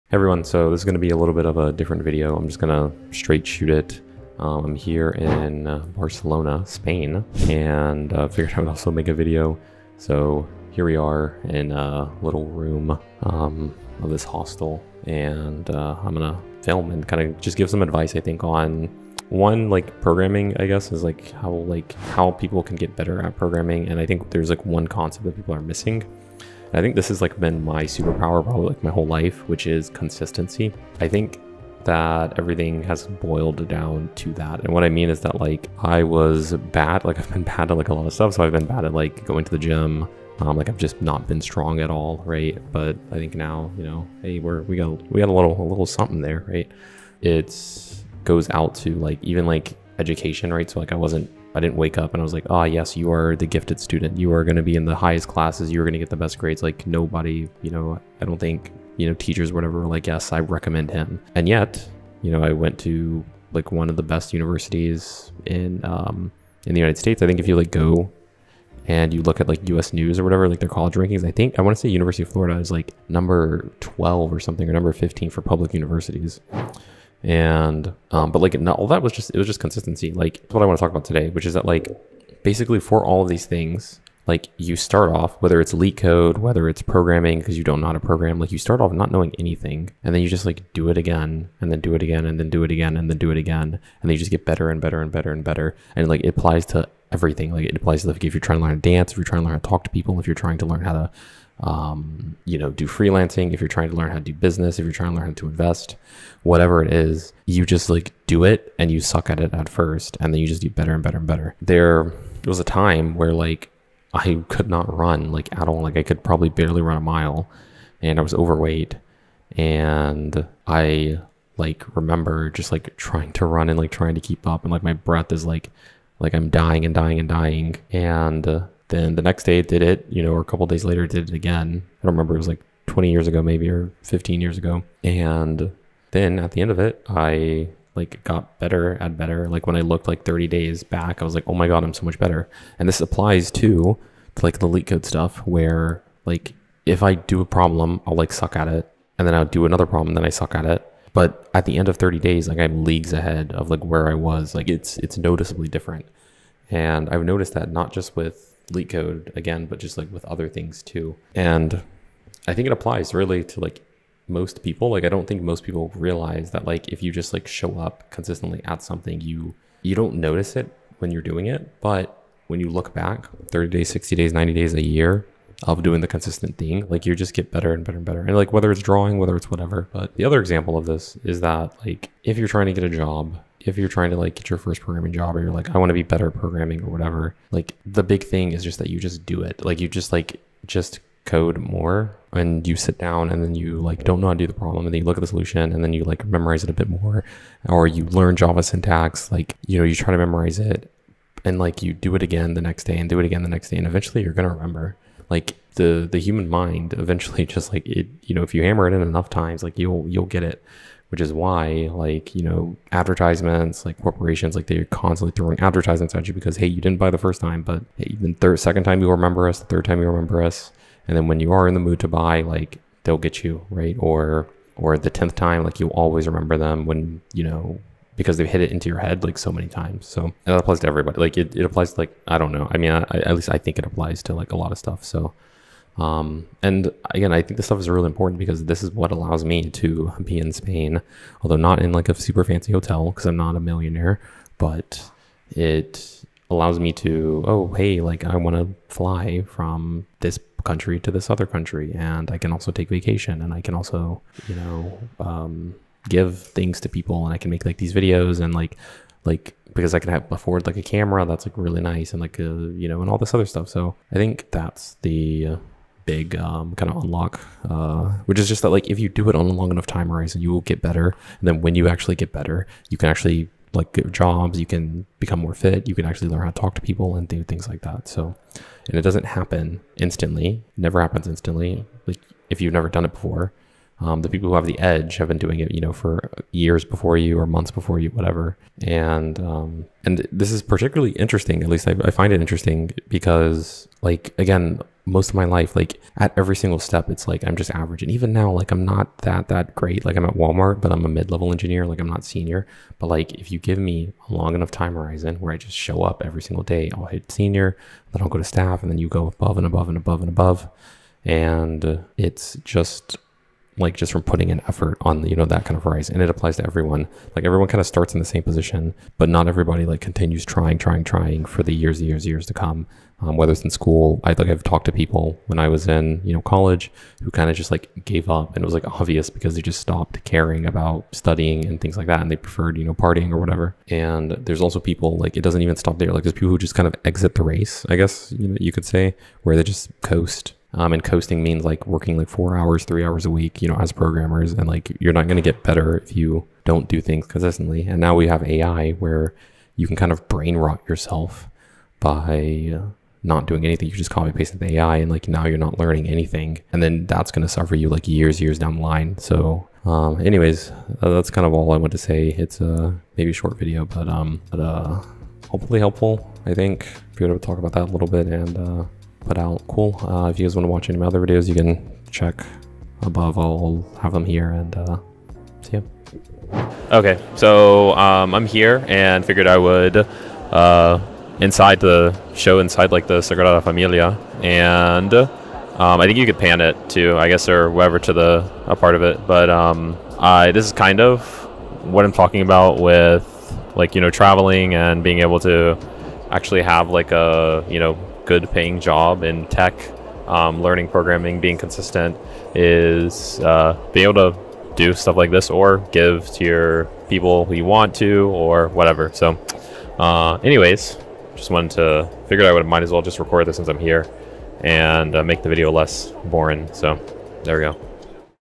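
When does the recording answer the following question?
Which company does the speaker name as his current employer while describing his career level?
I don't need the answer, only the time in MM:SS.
05:00.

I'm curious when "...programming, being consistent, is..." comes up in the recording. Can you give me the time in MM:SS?
06:40.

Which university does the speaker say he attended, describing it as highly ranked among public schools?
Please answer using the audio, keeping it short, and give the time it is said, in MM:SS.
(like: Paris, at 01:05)
University of Florida, at 01:11.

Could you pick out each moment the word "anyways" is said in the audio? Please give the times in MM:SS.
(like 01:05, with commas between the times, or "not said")
06:00, 06:50.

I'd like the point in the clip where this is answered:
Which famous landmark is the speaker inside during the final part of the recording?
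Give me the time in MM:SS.
06:23.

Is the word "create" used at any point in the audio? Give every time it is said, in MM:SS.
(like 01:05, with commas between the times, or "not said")
not said.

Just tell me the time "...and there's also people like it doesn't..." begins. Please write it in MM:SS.
05:33.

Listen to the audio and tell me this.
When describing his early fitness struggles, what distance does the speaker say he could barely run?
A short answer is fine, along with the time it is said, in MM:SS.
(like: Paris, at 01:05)
a mile, at 01:56.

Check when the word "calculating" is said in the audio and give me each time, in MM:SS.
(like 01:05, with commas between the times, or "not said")
not said.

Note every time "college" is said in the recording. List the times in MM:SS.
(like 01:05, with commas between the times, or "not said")
01:10, 05:26.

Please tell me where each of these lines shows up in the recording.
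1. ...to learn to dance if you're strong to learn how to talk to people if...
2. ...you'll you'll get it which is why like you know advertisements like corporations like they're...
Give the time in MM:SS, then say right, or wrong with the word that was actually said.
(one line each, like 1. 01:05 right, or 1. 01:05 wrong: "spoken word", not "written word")
1. 01:38 wrong: "trying", not "strong"
2. 03:29 right.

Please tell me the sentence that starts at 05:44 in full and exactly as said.
And like you're not going to get better if you don't do things consistently.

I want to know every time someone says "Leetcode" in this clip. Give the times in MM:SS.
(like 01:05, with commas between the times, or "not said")
01:25, 02:24, 02:38.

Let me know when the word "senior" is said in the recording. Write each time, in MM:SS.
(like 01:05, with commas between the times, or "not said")
05:02, 05:07.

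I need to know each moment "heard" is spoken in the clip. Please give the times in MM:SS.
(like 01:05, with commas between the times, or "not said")
not said.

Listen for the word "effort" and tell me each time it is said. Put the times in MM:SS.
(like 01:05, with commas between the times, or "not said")
05:14.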